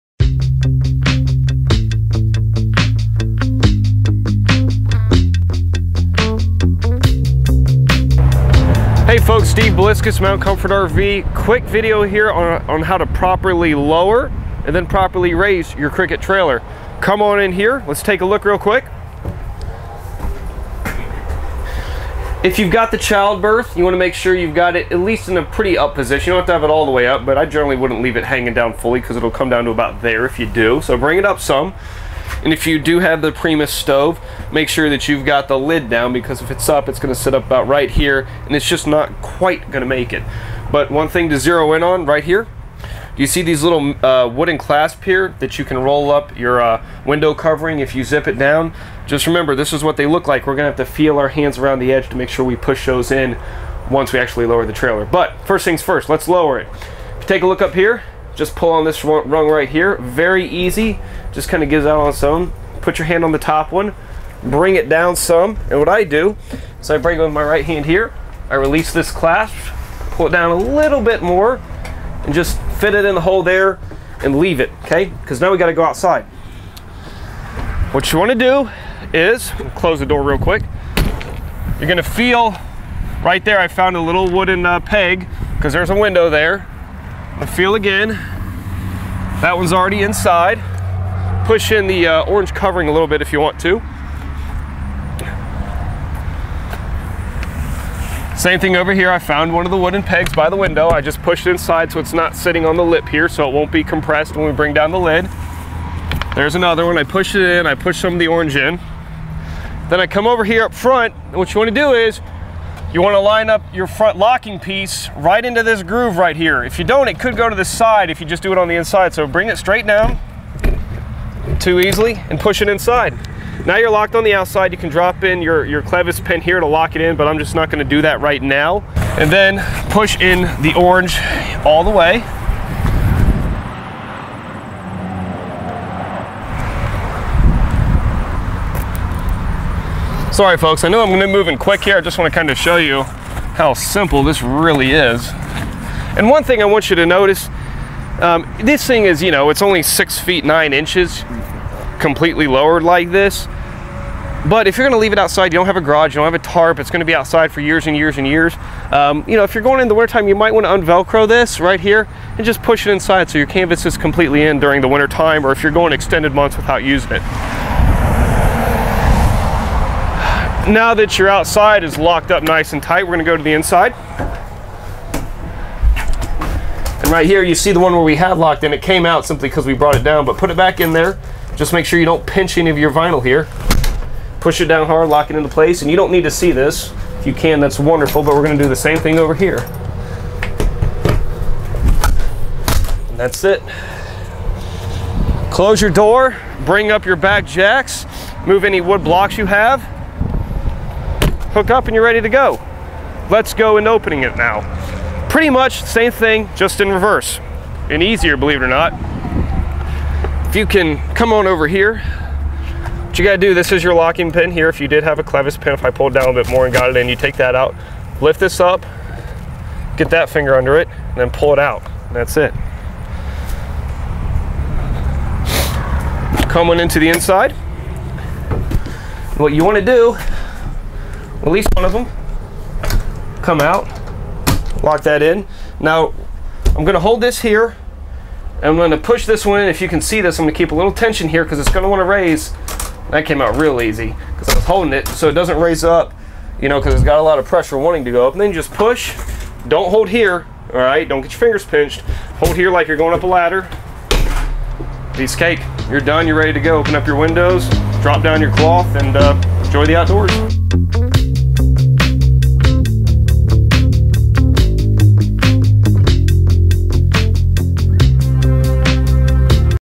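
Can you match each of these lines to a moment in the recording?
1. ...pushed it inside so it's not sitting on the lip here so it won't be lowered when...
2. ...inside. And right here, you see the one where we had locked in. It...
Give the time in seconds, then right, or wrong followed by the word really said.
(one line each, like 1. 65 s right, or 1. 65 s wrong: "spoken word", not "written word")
1. 101 s wrong: "compressed", not "lowered"
2. 173 s right.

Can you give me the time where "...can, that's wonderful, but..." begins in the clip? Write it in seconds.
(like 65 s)
187 s.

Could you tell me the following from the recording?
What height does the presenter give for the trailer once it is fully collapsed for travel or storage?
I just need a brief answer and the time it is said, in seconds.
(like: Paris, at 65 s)
6 feet 9 inches, at 149 s.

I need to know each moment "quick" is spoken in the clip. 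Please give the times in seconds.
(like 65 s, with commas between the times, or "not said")
11 s, 18 s, 80 s, 141 s.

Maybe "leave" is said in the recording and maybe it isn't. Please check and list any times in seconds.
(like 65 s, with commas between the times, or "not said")
28 s, 74 s, 154 s.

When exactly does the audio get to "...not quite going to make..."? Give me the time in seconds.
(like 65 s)
38 s.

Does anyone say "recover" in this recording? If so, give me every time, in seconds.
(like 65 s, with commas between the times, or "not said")
not said.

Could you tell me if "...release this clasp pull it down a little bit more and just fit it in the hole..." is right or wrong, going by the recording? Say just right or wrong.
right.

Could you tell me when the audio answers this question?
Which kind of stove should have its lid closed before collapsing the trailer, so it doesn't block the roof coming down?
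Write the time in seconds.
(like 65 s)
33 s.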